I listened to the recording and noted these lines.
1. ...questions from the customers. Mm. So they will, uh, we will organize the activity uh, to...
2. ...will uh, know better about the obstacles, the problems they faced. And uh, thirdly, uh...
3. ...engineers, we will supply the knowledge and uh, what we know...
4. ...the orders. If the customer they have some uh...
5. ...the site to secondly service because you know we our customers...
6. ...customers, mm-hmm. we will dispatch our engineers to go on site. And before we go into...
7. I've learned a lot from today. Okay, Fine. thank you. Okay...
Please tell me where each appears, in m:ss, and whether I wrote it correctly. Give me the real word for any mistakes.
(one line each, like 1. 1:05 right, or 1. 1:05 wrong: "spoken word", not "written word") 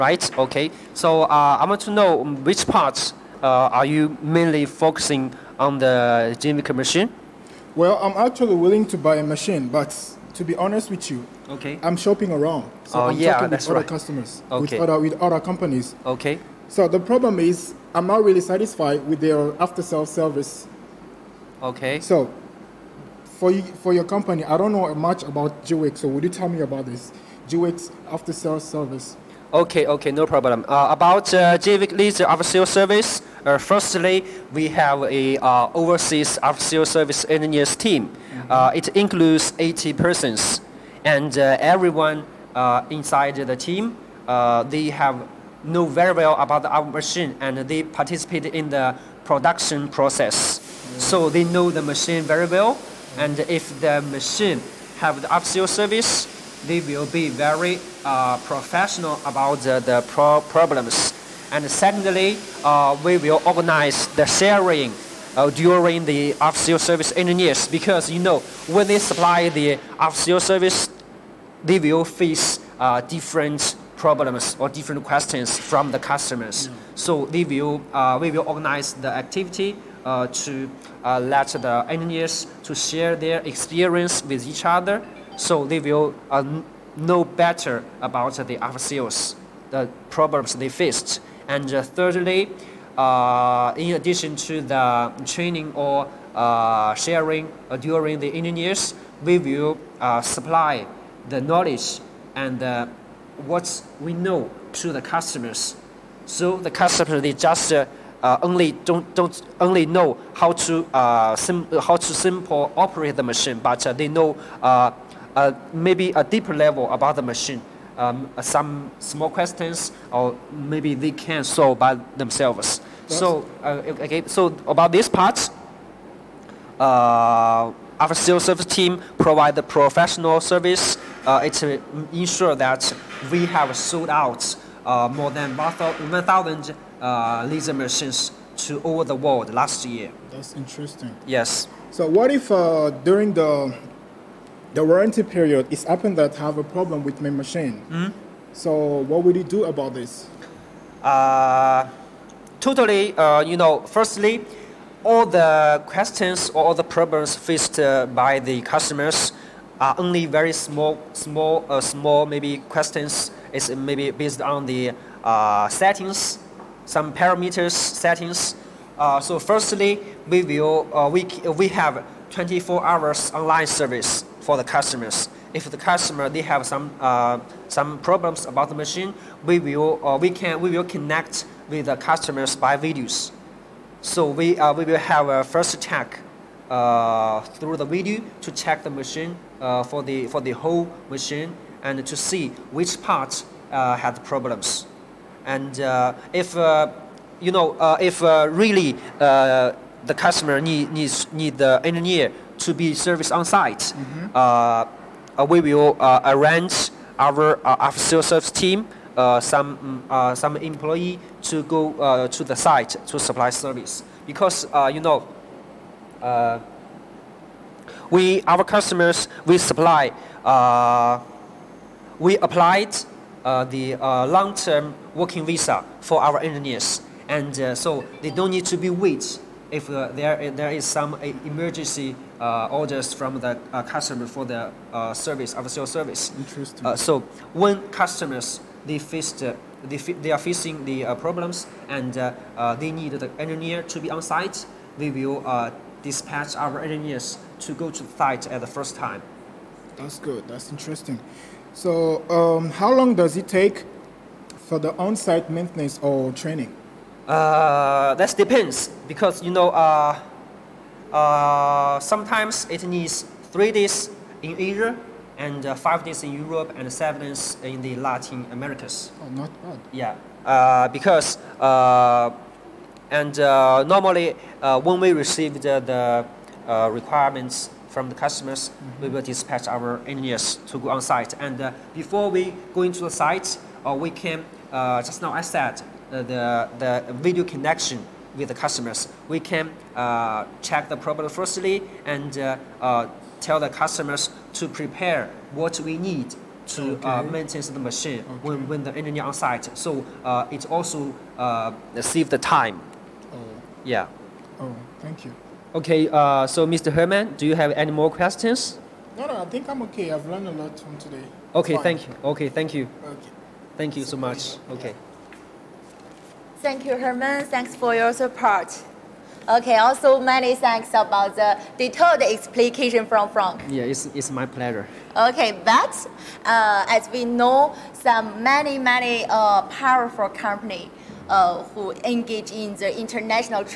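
1. 1:15 right
2. 1:25 right
3. 1:38 right
4. 2:54 wrong: "customers", not "orders"
5. 3:32 wrong: "supply", not "secondly"
6. 4:38 right
7. 5:10 right.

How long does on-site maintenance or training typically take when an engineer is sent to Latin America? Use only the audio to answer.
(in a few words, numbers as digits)
7 days.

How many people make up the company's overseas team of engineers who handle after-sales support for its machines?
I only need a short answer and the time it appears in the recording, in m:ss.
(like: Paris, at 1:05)
80, at 0:39.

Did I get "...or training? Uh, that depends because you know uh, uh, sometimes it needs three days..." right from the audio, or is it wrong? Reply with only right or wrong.
right.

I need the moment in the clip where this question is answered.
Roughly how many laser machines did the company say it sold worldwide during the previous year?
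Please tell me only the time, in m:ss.
2:15.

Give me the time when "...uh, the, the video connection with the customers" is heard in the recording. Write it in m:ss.
4:46.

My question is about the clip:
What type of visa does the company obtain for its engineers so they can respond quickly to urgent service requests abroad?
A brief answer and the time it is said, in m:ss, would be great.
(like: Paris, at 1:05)
Long-term working visa, at 3:44.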